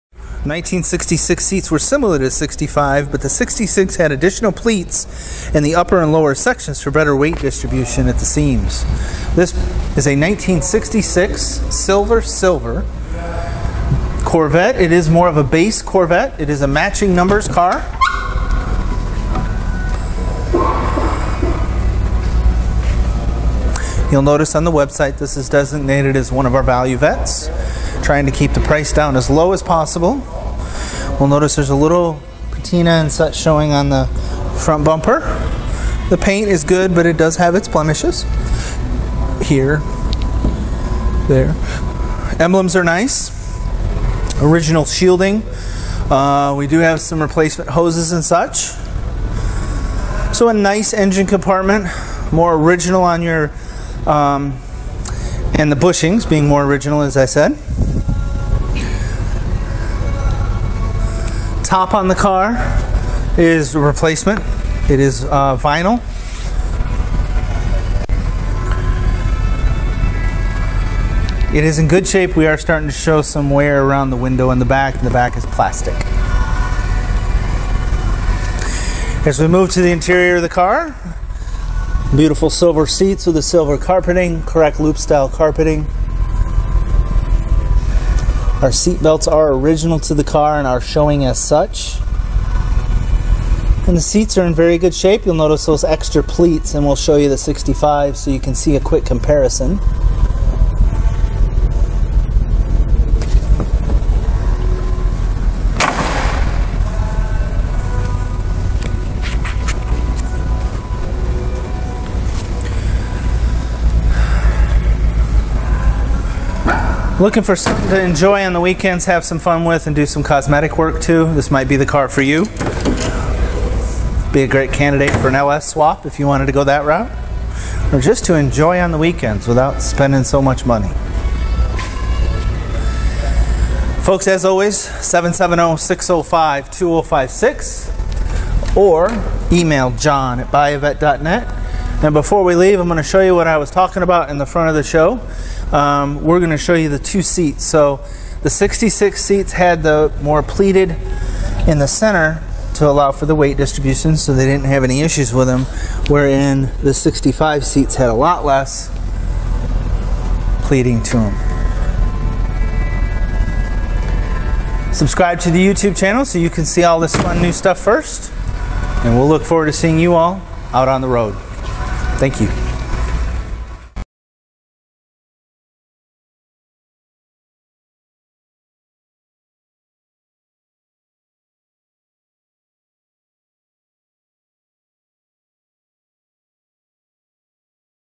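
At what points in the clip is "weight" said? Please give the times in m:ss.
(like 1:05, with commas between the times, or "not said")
0:07, 2:33.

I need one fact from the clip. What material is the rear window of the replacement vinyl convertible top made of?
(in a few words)
Plastic.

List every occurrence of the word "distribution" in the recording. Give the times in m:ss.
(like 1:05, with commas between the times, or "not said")
0:07, 2:33.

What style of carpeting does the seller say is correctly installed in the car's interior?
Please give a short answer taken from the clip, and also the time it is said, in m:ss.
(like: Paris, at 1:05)
Loop style, at 1:24.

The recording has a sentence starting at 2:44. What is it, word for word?
subscribe to the YouTube channel so you can see all this fun new stuff first.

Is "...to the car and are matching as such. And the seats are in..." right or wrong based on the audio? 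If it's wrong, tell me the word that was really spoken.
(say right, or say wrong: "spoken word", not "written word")
wrong: "showing", not "matching".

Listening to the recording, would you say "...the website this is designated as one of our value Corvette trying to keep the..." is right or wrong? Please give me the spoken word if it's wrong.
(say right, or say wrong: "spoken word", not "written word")
wrong: "Vettes", not "Corvette".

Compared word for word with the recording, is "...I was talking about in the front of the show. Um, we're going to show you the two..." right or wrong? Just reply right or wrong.
right.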